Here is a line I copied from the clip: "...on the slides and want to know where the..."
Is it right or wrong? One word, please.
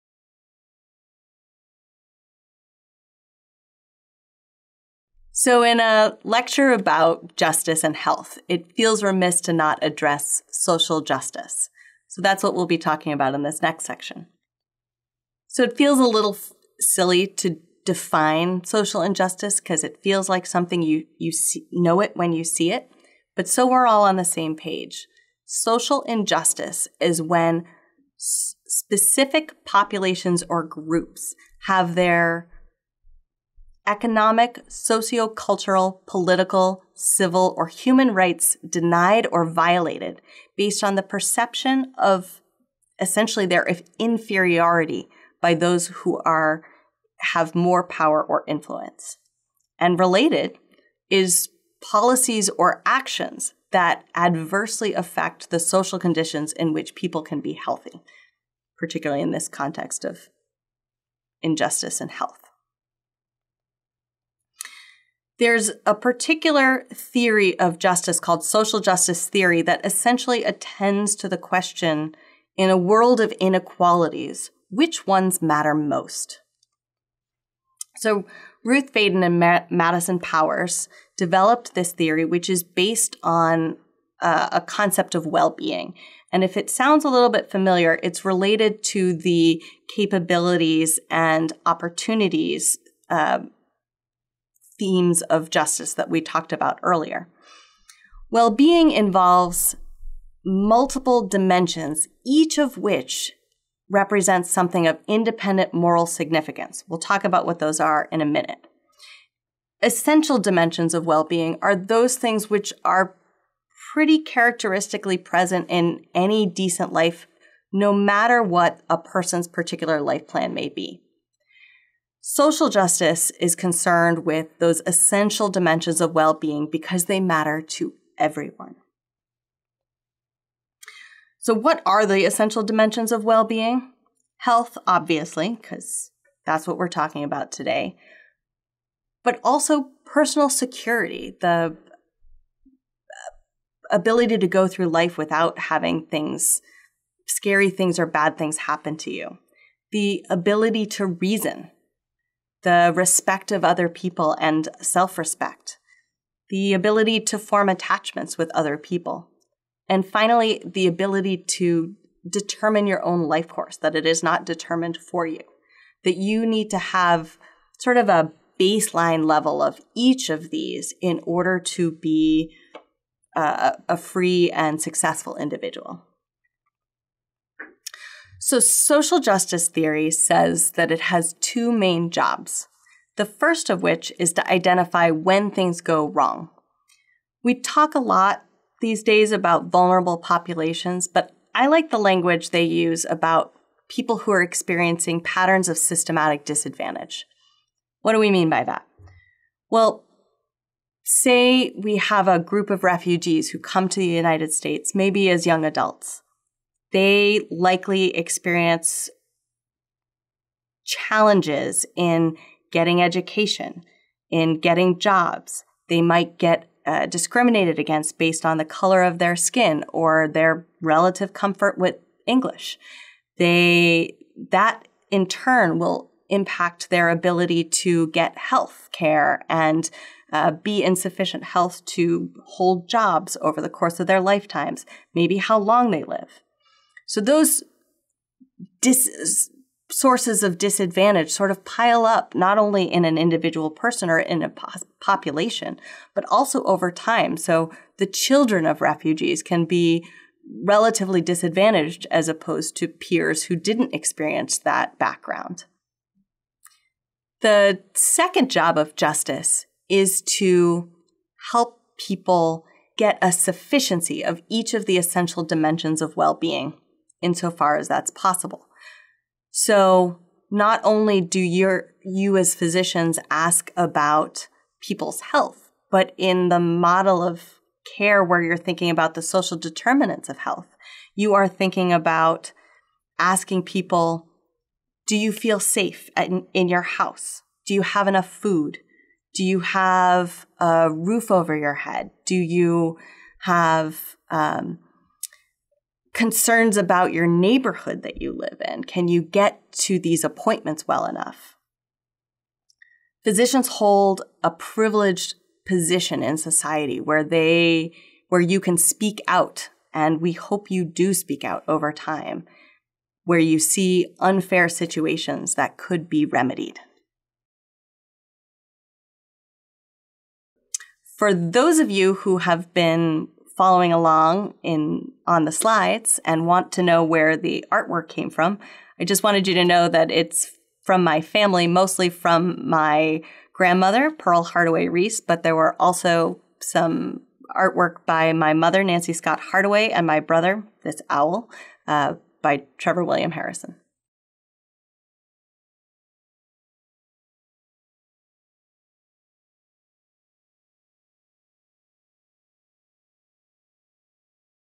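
right.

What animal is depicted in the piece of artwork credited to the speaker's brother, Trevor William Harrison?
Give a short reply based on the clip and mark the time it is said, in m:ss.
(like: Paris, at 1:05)
Owl, at 5:41.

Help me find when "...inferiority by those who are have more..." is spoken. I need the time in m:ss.
0:43.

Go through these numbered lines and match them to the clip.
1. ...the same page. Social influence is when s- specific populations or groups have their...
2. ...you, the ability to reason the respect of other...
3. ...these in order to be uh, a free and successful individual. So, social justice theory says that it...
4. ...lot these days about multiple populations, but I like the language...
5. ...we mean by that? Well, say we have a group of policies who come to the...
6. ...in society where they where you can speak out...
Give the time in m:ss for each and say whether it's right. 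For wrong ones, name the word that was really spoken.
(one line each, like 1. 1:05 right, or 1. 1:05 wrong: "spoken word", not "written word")
1. 0:24 wrong: "injustice", not "influence"
2. 2:29 right
3. 2:50 right
4. 3:07 wrong: "vulnerable", not "multiple"
5. 3:18 wrong: "refugees", not "policies"
6. 5:06 right.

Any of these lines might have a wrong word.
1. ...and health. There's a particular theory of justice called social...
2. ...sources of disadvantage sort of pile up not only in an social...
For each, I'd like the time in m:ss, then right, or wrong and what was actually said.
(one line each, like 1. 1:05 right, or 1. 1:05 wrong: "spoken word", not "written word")
1. 1:02 right
2. 3:59 wrong: "individual", not "social".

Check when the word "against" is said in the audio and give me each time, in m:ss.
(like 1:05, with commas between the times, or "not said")
3:37.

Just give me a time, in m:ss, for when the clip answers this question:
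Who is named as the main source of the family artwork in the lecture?
5:34.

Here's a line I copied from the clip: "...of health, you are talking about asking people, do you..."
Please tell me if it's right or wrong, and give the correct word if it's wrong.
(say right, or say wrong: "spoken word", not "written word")
wrong: "thinking", not "talking".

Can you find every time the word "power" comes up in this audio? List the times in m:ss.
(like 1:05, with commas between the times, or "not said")
0:47, 1:20.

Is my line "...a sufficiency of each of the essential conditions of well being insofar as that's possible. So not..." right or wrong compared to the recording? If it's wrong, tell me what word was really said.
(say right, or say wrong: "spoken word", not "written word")
wrong: "dimensions", not "conditions".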